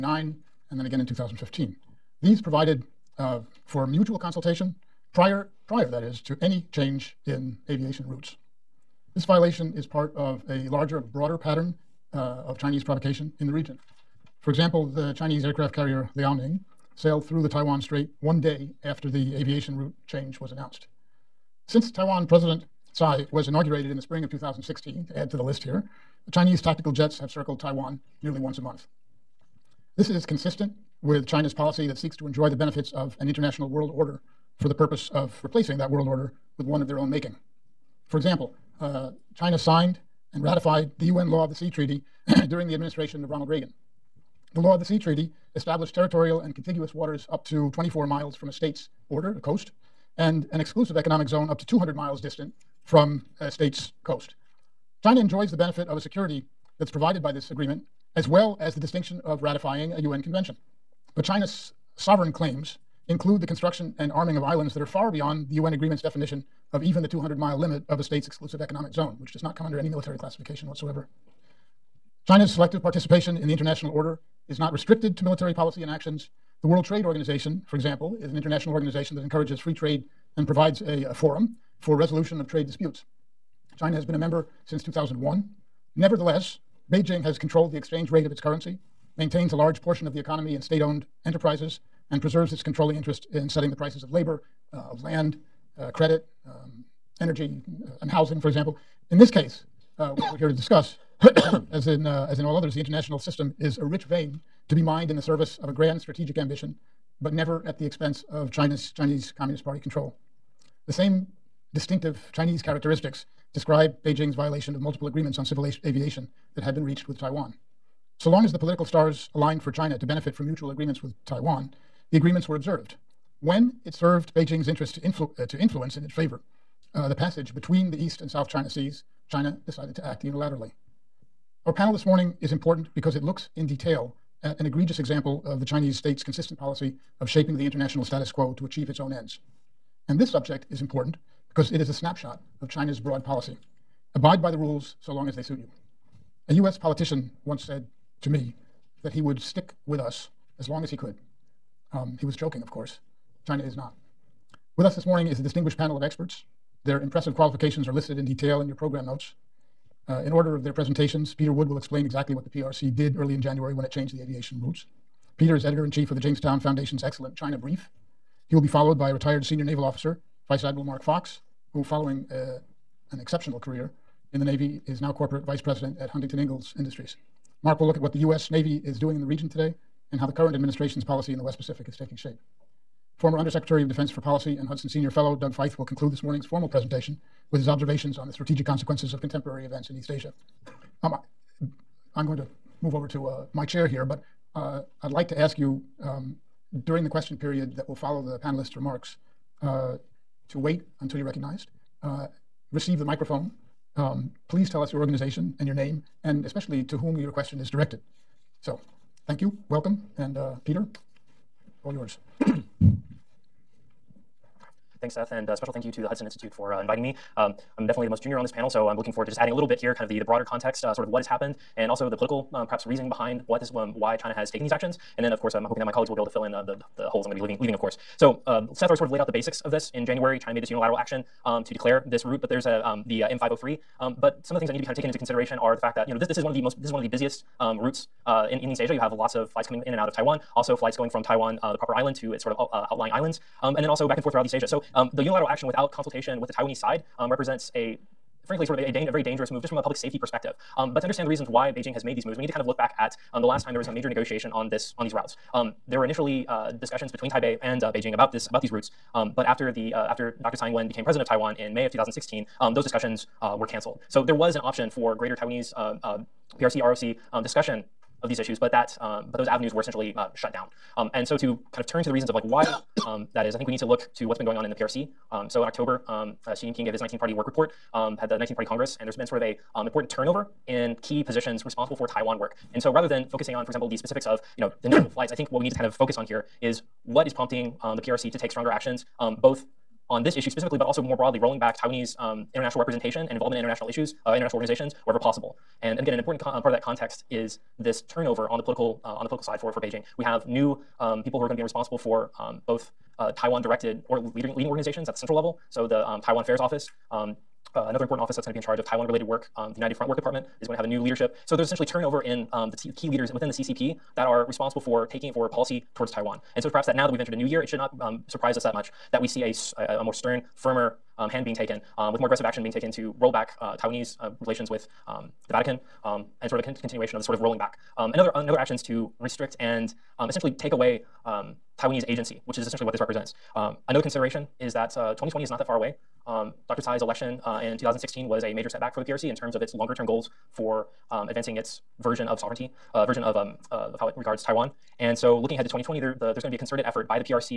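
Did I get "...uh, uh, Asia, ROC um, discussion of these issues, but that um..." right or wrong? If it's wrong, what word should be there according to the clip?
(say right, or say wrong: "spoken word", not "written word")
wrong: "PRC", not "Asia".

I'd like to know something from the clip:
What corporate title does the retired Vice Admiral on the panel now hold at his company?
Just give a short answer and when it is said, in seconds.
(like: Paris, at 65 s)
corporate vice president, at 175 s.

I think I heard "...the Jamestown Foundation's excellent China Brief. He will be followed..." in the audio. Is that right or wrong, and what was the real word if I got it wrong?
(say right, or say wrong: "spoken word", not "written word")
right.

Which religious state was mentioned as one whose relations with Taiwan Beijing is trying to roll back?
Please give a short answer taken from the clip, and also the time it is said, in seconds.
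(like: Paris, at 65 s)
the Vatican, at 325 s.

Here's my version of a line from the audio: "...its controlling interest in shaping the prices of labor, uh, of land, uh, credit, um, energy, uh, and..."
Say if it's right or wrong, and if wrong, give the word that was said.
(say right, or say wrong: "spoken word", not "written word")
wrong: "setting", not "shaping".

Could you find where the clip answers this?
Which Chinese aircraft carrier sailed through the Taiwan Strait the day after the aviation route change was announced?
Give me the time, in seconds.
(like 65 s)
16 s.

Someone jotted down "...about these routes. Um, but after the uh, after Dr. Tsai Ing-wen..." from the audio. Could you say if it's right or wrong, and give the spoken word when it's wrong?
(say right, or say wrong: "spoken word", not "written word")
right.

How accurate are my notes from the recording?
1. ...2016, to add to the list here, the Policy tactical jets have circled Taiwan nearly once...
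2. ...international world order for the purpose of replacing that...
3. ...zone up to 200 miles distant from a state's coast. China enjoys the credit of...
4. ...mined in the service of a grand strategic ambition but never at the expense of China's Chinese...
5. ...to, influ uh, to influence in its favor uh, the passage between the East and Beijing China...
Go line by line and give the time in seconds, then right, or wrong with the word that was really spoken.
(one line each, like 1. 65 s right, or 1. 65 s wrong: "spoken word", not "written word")
1. 24 s wrong: "Chinese", not "Policy"
2. 33 s right
3. 51 s wrong: "benefit", not "credit"
4. 104 s right
5. 124 s wrong: "South", not "Beijing".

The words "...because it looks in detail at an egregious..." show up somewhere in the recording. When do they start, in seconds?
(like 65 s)
132 s.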